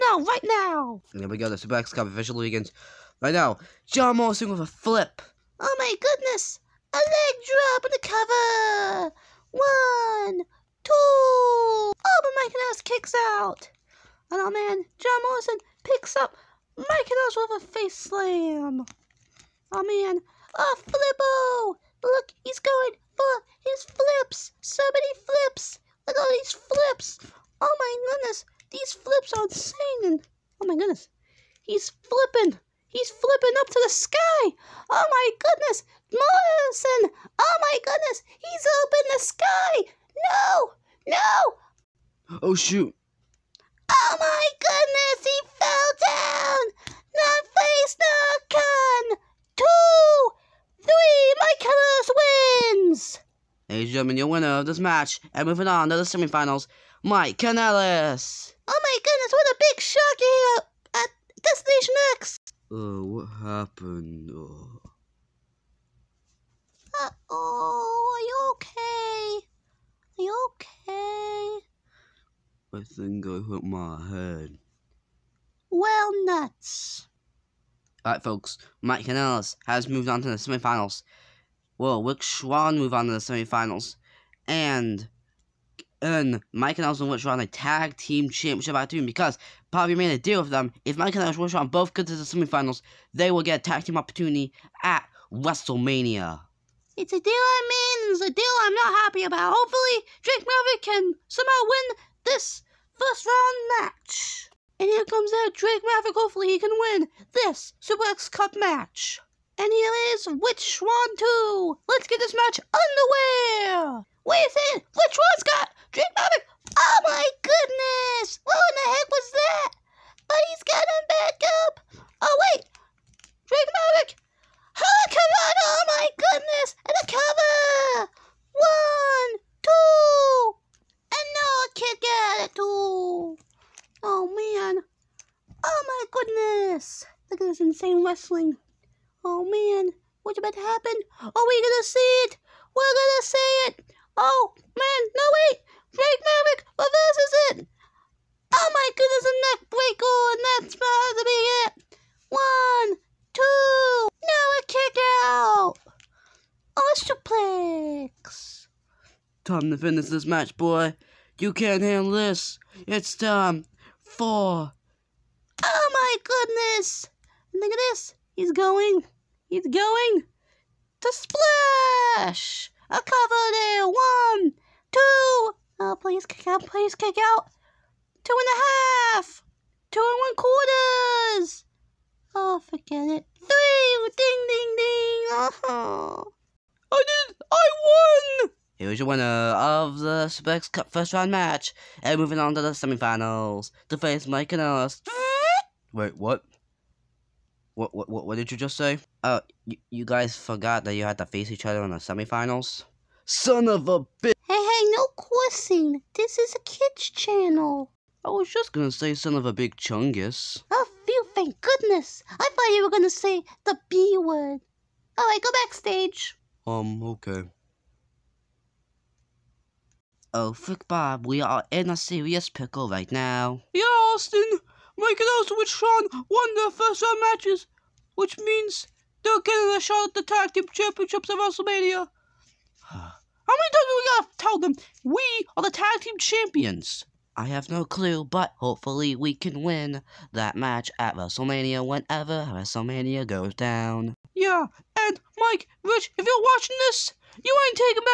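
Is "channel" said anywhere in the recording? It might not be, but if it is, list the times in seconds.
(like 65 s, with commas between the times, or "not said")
207 s.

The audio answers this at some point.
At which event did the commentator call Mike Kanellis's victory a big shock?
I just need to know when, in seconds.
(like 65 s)
61 s.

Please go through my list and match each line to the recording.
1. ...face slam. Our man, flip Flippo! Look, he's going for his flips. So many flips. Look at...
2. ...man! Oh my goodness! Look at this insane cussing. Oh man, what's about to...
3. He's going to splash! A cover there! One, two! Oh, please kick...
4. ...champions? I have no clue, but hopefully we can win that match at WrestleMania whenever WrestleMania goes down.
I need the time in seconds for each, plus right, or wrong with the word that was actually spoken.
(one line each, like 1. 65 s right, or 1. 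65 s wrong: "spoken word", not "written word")
1. 17 s right
2. 134 s wrong: "wrestling", not "cussing"
3. 169 s right
4. 236 s right.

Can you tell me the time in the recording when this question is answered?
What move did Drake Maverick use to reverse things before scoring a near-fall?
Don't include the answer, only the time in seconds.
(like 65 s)
149 s.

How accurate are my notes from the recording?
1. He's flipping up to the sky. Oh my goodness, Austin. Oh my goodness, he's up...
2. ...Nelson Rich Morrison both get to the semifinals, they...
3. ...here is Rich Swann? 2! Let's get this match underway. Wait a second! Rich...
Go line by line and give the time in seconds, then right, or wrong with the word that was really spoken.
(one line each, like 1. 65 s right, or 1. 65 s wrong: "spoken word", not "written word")
1. 32 s wrong: "Morrison", not "Austin"
2. 91 s wrong: "Swann", not "Morrison"
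3. 109 s right.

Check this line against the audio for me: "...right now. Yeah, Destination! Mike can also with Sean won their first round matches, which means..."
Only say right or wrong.
wrong.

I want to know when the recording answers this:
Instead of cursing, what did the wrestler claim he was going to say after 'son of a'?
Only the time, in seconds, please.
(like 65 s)
209 s.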